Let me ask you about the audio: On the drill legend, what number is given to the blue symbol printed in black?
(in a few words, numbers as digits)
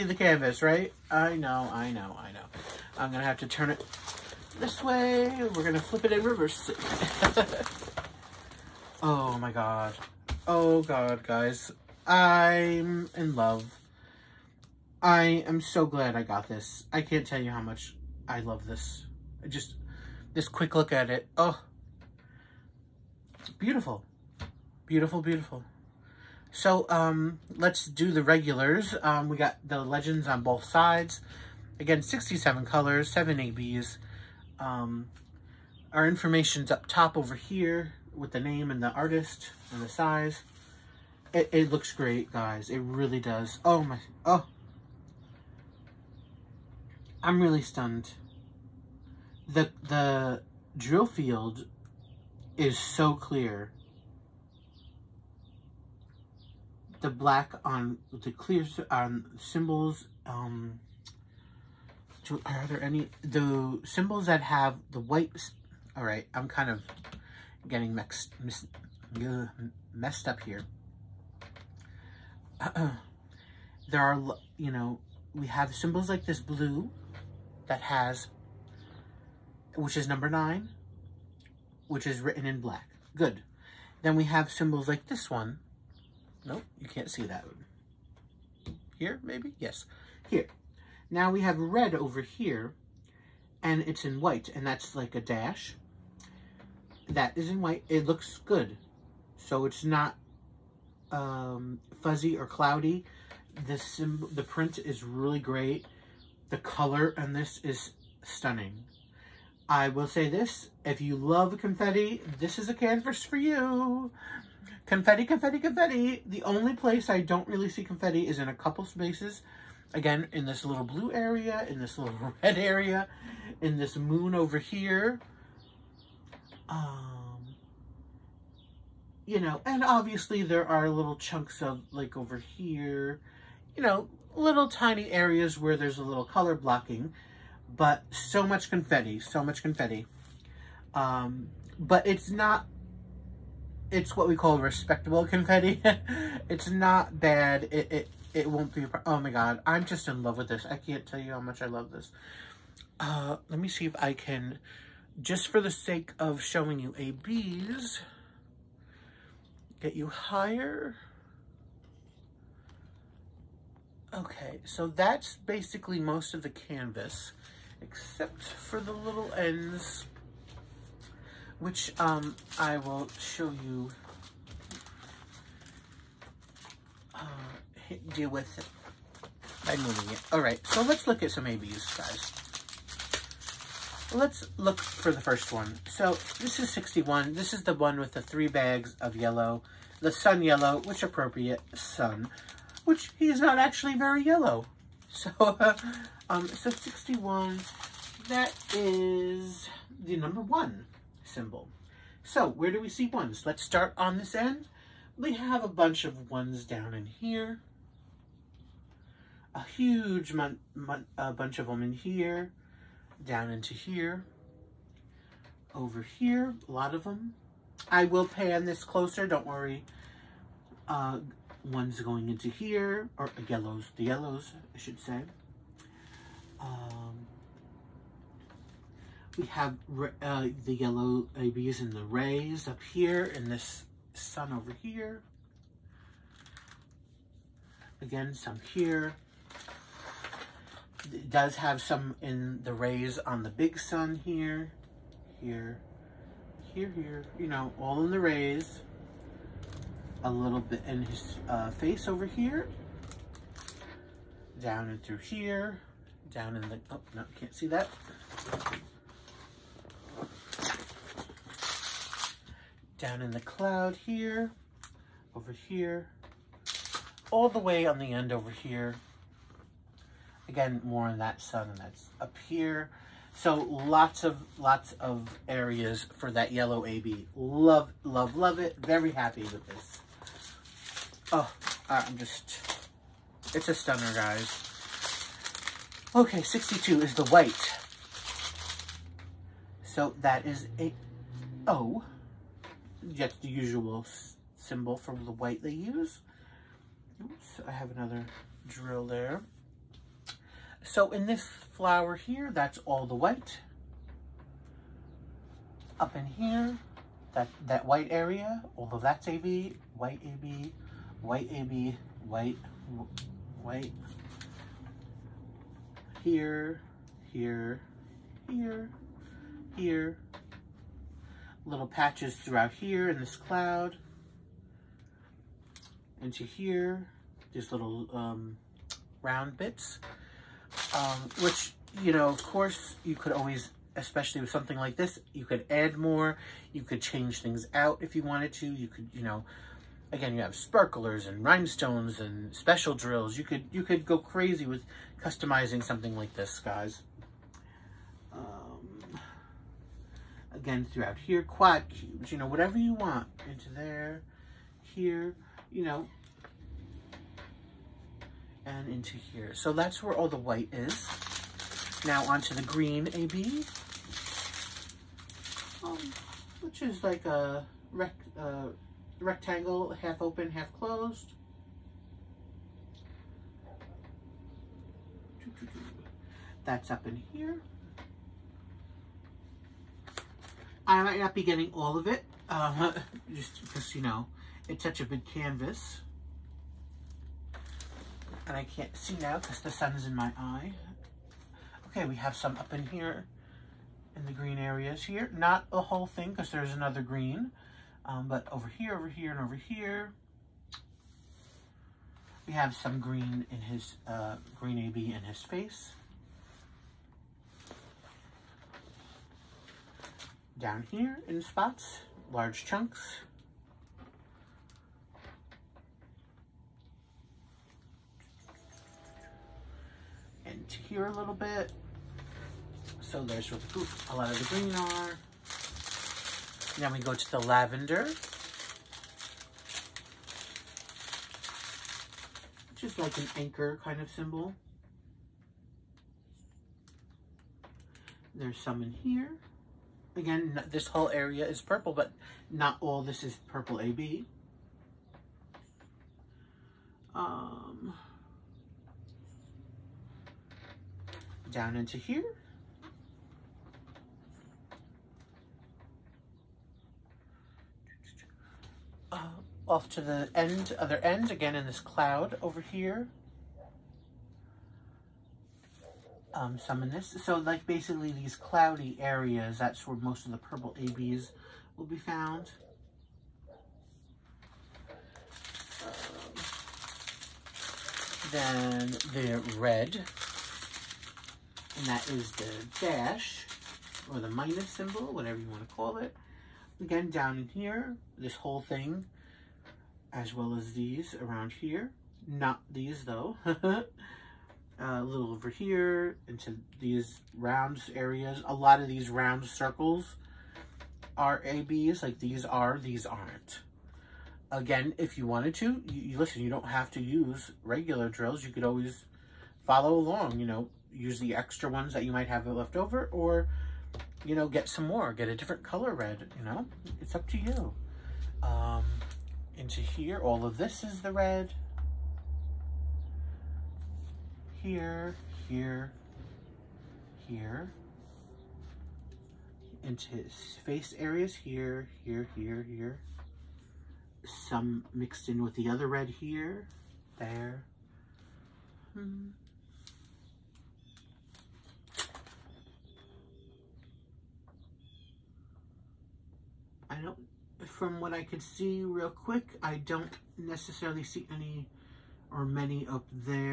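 9.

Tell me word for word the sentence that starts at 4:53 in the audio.
That's the usual symbol from the white they use.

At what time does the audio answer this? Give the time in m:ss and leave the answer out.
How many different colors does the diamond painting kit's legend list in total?
0:32.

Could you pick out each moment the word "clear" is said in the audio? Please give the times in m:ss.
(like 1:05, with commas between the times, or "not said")
0:53, 0:58.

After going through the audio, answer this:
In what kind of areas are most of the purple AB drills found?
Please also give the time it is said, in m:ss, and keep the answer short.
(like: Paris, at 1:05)
cloudy areas, at 7:48.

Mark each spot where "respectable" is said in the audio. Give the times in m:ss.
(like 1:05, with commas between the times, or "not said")
2:24.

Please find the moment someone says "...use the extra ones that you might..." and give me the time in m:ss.
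8:30.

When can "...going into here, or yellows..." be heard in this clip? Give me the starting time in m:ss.
3:42.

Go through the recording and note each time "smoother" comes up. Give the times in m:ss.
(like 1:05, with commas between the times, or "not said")
not said.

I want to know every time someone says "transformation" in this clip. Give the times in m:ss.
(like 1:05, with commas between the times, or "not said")
not said.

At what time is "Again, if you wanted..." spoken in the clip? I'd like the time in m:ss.
8:24.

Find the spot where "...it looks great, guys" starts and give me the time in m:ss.
0:41.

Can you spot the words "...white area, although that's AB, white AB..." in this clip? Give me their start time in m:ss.
5:07.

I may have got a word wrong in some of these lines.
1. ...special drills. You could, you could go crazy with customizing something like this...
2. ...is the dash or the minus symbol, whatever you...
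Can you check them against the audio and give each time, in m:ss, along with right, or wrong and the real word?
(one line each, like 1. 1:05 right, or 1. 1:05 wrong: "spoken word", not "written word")
1. 5:42 right
2. 8:02 right.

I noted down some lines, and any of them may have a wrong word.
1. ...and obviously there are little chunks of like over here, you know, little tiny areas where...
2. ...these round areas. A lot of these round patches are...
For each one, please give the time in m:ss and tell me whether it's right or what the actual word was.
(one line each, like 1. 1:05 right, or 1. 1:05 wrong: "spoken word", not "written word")
1. 2:09 right
2. 8:16 wrong: "circles", not "patches".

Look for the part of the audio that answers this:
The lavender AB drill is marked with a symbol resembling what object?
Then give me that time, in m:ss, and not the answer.
7:13.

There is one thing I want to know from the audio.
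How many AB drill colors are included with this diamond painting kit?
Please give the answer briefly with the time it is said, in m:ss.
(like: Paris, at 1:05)
7, at 0:33.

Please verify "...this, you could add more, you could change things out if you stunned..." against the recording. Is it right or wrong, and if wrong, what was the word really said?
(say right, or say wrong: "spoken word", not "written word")
wrong: "wanted", not "stunned".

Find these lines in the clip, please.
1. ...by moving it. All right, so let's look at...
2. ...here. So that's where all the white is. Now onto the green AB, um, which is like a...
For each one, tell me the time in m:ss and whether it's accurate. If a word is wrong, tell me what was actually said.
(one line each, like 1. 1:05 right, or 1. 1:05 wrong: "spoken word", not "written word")
1. 2:59 right
2. 5:59 right.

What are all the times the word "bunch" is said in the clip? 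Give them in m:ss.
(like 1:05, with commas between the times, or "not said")
3:25, 3:31.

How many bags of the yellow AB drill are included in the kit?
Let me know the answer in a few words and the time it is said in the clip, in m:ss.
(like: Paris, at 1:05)
3, at 3:08.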